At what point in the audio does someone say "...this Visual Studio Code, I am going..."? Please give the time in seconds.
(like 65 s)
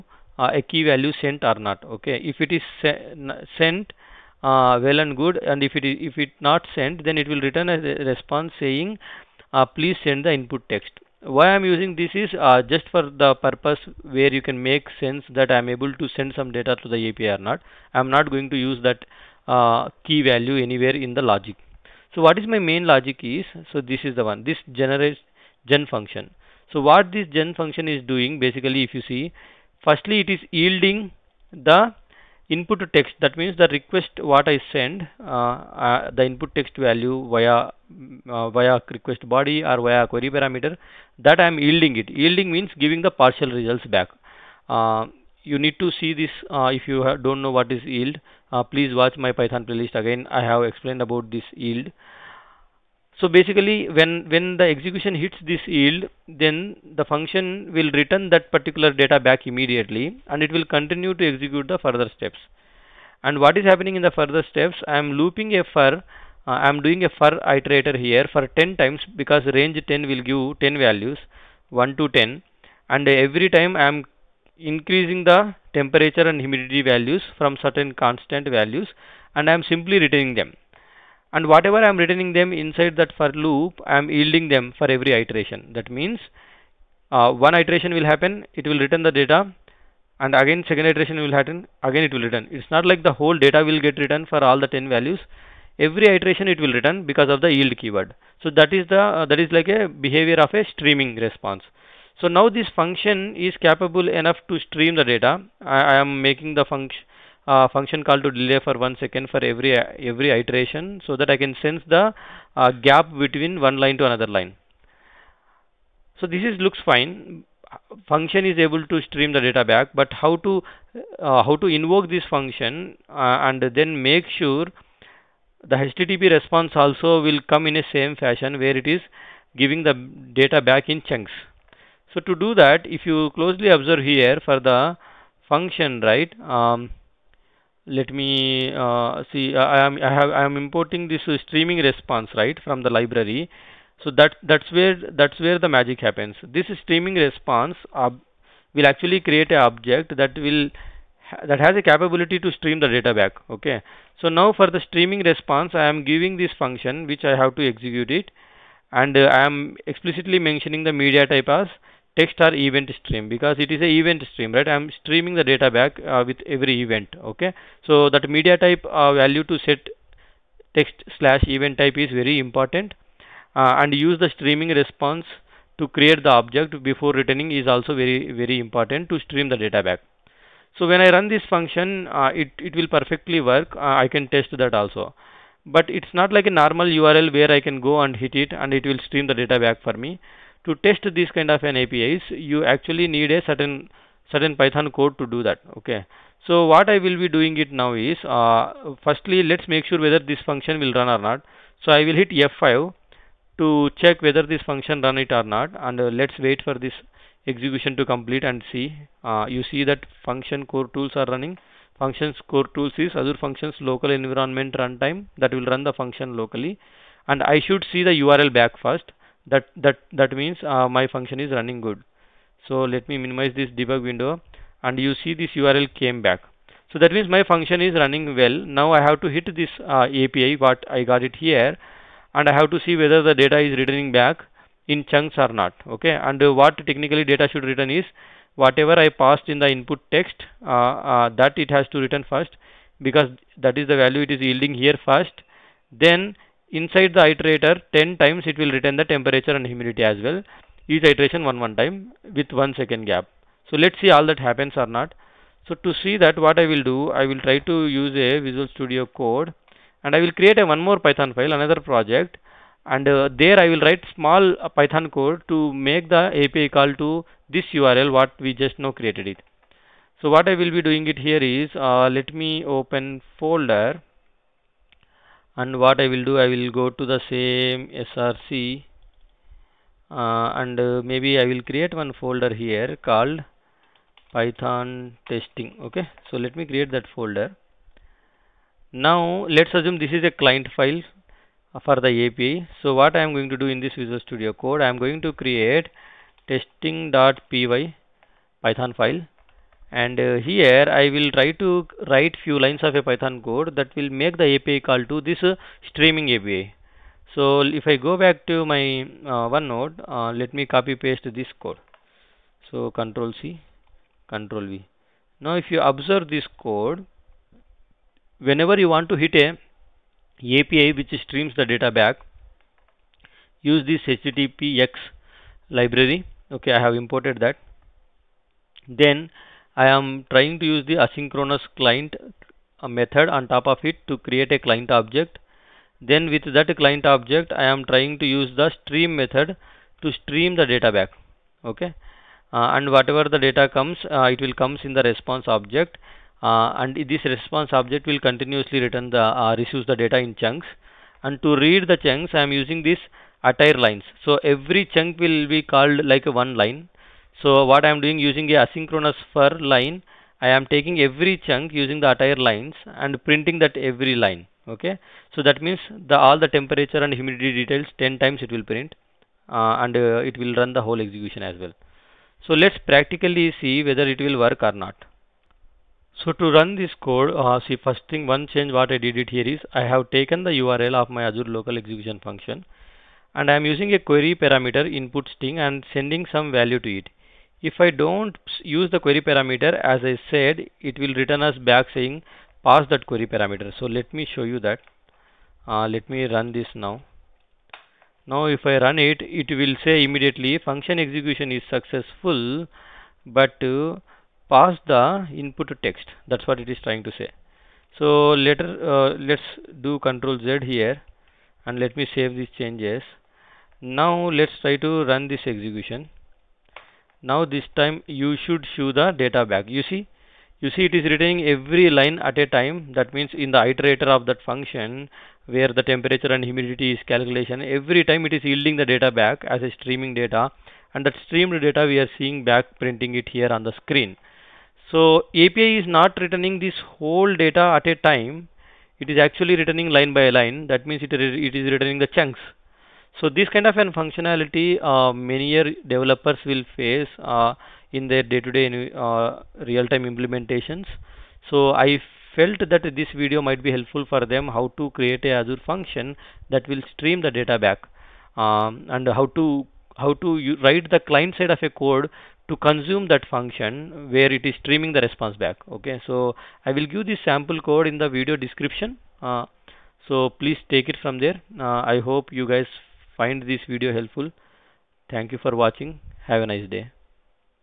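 293 s.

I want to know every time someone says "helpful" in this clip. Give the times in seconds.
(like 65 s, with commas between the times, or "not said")
453 s, 473 s.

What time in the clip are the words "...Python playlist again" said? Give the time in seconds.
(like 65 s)
49 s.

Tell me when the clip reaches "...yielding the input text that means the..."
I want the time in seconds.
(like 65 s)
30 s.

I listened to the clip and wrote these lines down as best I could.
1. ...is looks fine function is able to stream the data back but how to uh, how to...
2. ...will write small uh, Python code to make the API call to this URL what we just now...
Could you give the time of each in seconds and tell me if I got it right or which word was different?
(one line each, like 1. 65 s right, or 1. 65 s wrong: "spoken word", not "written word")
1. 116 s right
2. 263 s right.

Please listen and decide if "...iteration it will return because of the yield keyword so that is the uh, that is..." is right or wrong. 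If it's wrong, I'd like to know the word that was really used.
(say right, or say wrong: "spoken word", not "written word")
right.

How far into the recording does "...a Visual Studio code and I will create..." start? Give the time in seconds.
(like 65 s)
258 s.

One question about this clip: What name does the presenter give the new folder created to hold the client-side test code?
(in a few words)
python testing.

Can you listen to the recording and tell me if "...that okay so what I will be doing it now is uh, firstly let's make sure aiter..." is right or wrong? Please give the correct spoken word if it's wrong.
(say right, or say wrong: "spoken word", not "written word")
wrong: "whether", not "aiter".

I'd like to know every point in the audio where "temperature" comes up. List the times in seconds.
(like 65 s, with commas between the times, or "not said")
75 s, 249 s, 366 s, 425 s.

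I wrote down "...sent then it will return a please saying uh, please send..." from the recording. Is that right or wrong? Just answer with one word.
wrong.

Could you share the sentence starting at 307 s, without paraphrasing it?
So if I go back to my uh, OneNote, uh, let me copy paste this code.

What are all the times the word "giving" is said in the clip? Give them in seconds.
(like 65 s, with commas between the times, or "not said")
42 s, 129 s, 156 s.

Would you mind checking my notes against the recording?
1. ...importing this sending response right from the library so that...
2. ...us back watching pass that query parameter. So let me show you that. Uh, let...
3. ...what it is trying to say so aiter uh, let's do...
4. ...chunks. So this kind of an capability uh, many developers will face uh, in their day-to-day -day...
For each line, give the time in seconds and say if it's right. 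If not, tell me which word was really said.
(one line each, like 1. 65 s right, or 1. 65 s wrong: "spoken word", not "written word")
1. 140 s wrong: "streaming", not "sending"
2. 391 s wrong: "saying", not "watching"
3. 406 s wrong: "later", not "aiter"
4. 442 s wrong: "functionality", not "capability".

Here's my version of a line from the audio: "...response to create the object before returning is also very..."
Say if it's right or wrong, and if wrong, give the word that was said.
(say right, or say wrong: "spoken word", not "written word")
right.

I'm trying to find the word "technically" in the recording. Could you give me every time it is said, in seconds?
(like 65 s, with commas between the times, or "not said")
236 s.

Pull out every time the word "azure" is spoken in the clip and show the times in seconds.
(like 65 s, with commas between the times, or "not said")
213 s, 381 s, 455 s.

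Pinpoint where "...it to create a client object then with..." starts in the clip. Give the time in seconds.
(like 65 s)
333 s.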